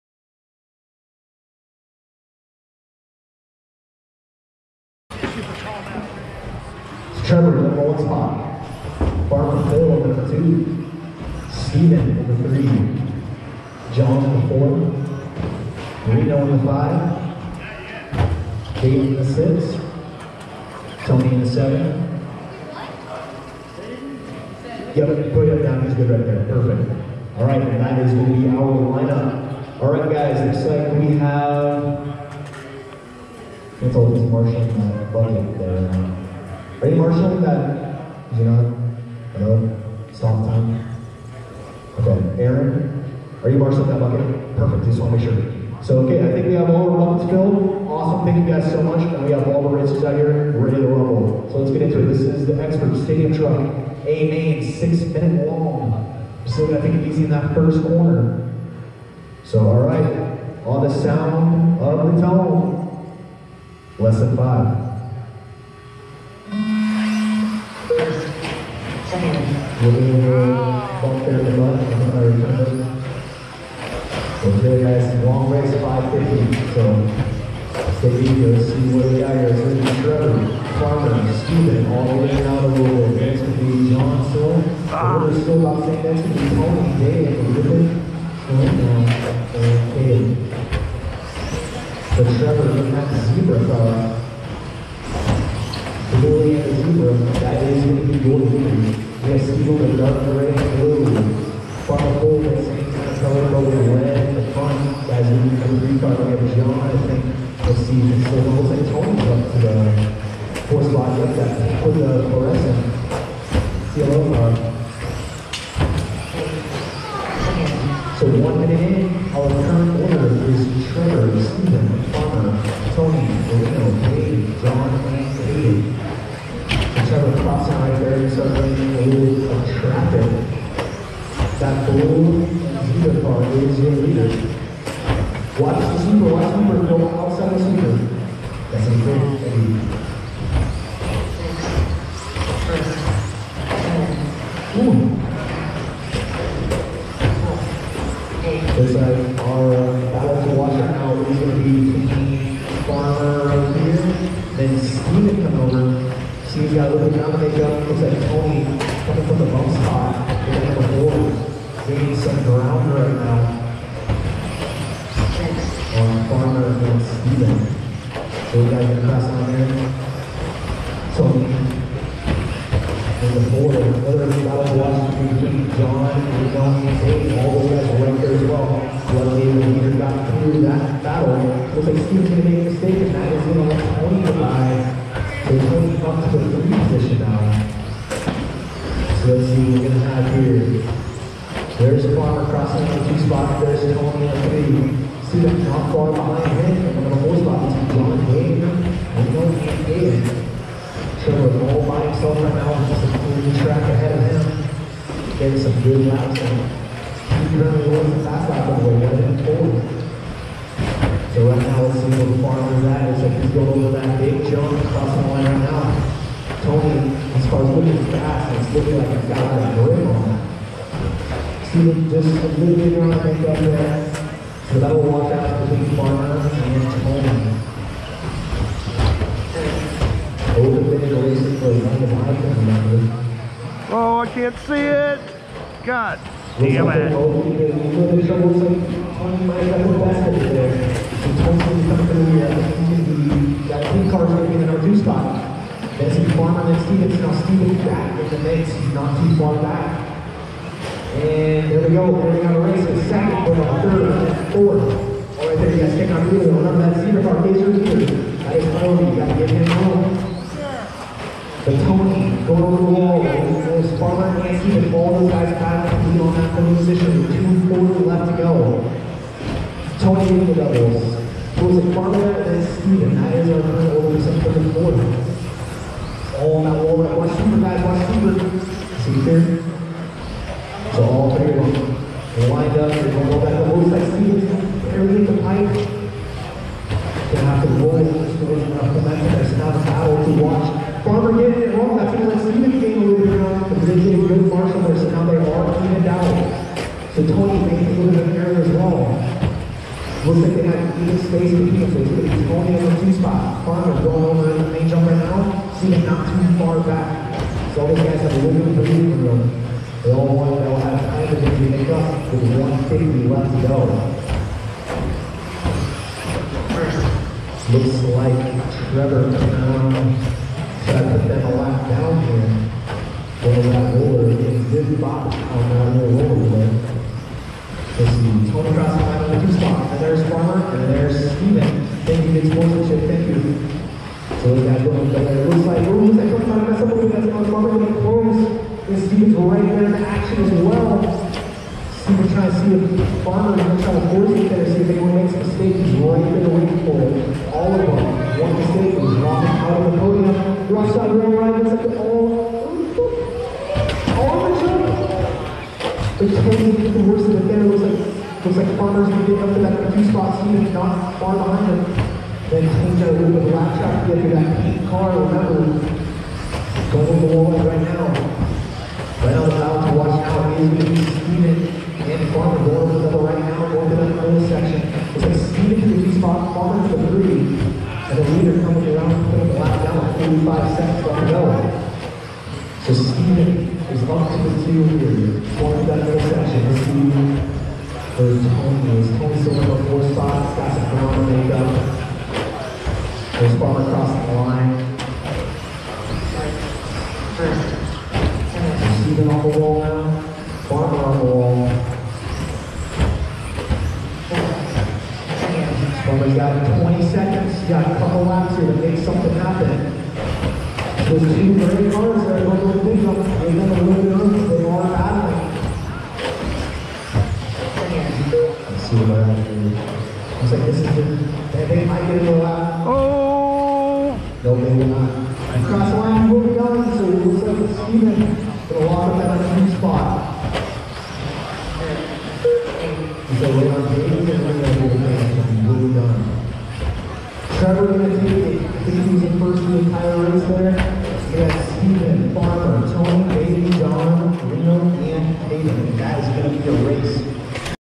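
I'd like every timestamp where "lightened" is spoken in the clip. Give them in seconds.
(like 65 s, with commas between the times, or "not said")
not said.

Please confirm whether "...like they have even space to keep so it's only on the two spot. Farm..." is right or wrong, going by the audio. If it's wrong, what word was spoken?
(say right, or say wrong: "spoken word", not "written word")
right.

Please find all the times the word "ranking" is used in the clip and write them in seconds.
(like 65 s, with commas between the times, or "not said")
not said.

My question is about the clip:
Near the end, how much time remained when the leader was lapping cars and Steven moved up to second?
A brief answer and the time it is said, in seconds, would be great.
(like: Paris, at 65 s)
45 seconds, at 380 s.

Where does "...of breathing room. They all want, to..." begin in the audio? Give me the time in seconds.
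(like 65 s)
308 s.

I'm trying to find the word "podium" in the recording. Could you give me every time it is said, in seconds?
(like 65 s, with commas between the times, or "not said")
266 s, 349 s.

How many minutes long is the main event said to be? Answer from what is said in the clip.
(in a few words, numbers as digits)
6.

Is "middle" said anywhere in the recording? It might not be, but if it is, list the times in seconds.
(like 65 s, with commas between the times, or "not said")
374 s, 386 s.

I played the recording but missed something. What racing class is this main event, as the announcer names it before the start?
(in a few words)
Expert Stadium Truck.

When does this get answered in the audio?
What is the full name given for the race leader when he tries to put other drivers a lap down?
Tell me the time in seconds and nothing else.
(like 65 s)
318 s.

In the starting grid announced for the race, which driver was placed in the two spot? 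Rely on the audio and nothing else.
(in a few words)
Farmer Phil.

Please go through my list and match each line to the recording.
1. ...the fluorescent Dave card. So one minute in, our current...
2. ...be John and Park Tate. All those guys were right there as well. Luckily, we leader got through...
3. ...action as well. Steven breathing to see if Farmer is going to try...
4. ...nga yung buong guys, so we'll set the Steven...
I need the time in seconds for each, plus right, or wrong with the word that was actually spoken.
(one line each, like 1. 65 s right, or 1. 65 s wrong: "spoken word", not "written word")
1. 111 s wrong: "CLO", not "Dave"
2. 175 s wrong: "John", not "Park"
3. 339 s wrong: "trying", not "breathing"
4. 426 s right.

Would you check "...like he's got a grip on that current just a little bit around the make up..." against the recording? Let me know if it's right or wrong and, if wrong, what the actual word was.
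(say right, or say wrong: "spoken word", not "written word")
wrong: "student", not "current".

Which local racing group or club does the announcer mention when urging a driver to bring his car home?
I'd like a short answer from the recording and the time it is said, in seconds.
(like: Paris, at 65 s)
Cedar Park Pacers, at 257 s.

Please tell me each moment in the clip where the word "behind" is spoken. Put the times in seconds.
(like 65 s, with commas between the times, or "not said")
196 s, 361 s.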